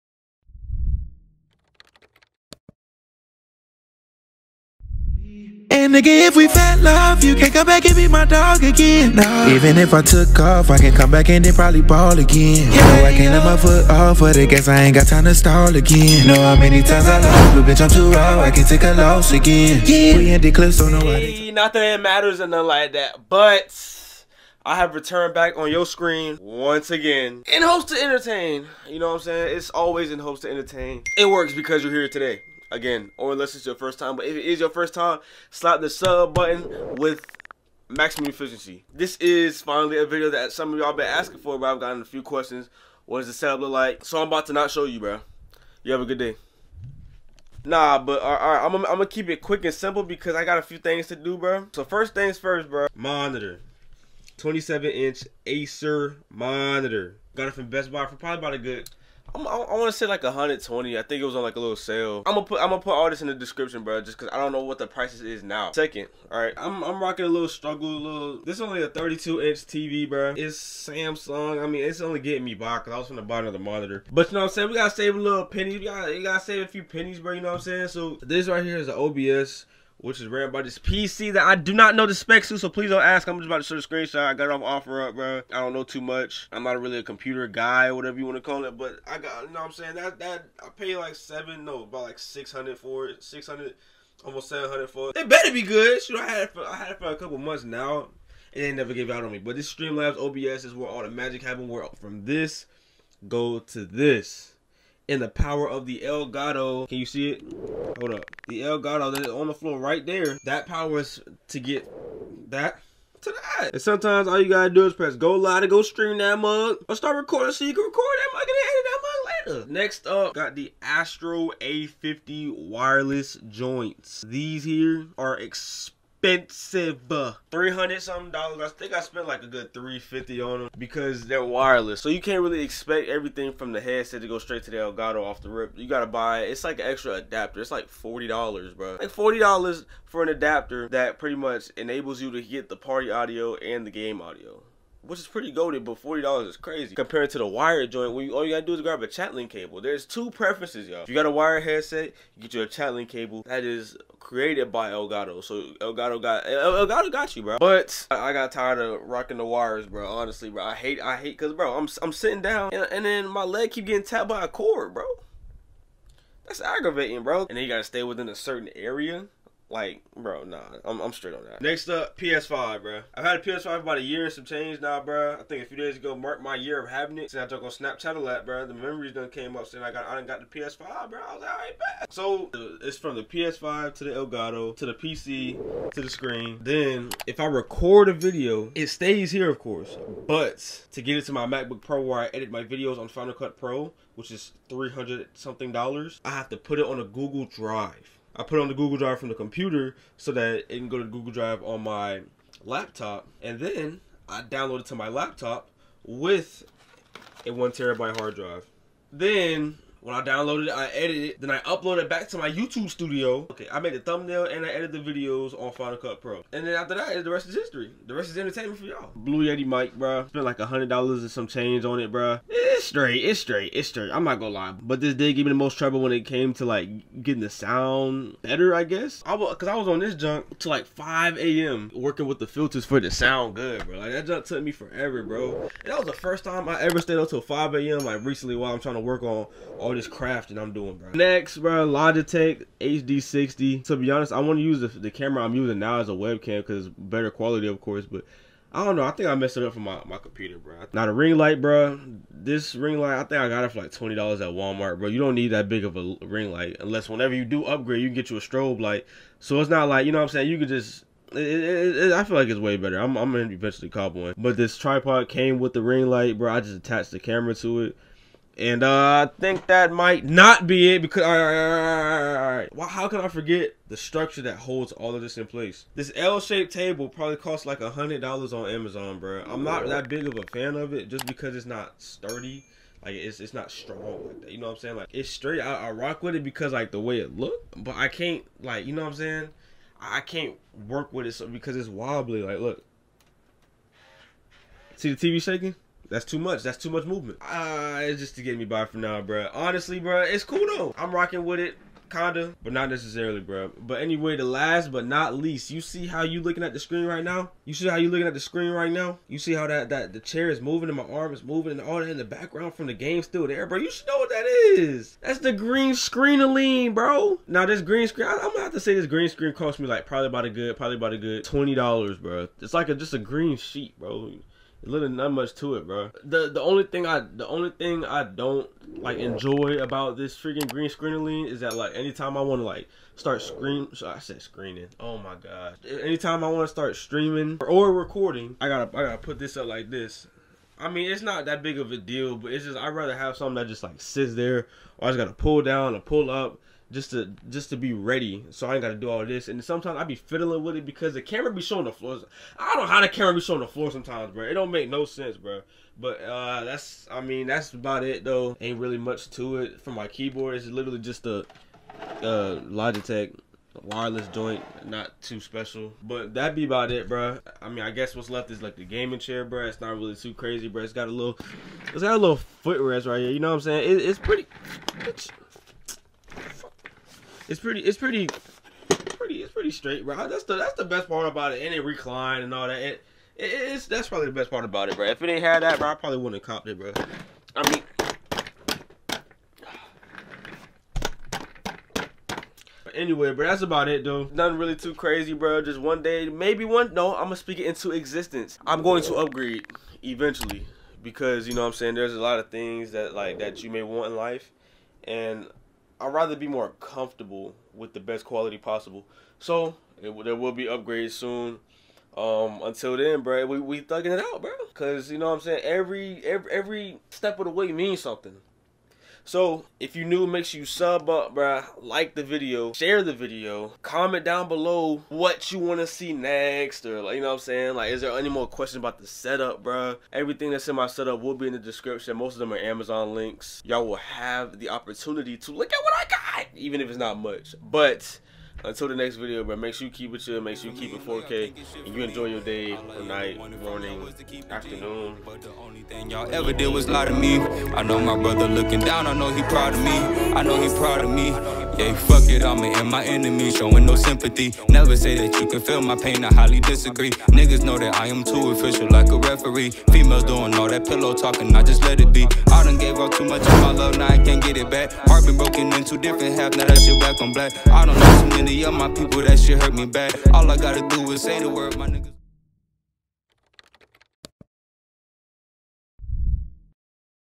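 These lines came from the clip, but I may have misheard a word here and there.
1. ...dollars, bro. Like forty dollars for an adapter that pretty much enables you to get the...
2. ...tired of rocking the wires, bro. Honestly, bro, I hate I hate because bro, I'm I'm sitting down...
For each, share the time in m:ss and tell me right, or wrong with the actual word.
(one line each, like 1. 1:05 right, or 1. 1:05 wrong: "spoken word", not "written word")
1. 2:18 right
2. 2:38 right.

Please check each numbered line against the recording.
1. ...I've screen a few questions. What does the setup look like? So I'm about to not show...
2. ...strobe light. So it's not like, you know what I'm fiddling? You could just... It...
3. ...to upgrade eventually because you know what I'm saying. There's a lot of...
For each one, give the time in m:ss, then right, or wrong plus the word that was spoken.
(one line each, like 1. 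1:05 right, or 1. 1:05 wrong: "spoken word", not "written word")
1. 0:41 wrong: "gotten", not "screen"
2. 4:18 wrong: "saying", not "fiddling"
3. 6:39 right.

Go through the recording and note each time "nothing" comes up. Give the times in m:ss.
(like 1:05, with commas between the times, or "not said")
0:22, 6:34.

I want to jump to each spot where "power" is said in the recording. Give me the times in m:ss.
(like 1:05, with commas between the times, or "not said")
1:45, 1:50.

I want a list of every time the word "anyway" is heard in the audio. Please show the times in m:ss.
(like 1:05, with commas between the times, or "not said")
5:04, 6:32.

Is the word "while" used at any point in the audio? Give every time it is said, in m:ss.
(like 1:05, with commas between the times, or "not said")
3:58.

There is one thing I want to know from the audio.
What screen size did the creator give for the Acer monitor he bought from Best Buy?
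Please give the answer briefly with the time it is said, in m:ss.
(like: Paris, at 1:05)
27 inch, at 0:54.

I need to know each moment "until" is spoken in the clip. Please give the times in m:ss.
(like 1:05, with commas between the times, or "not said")
6:52, 7:18.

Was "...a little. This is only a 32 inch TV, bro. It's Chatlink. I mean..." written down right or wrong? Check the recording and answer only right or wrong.
wrong.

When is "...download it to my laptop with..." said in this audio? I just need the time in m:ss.
3:24.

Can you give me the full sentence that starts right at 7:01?
Like the video, share the video, comment down below what you want to see next, or like you know what I'm saying.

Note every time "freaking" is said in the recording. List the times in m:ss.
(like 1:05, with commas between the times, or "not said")
5:30.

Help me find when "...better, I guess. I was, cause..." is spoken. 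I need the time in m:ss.
3:48.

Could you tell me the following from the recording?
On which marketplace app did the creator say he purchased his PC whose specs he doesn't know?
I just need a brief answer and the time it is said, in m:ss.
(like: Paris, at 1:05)
OfferUp, at 1:24.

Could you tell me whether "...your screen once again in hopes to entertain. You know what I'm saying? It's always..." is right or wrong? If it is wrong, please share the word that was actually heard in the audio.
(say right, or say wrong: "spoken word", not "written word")
right.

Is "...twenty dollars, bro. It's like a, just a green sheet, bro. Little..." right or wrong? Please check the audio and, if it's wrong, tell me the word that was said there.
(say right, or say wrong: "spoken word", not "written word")
right.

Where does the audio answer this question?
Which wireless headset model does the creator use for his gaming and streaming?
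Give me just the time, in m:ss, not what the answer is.
2:00.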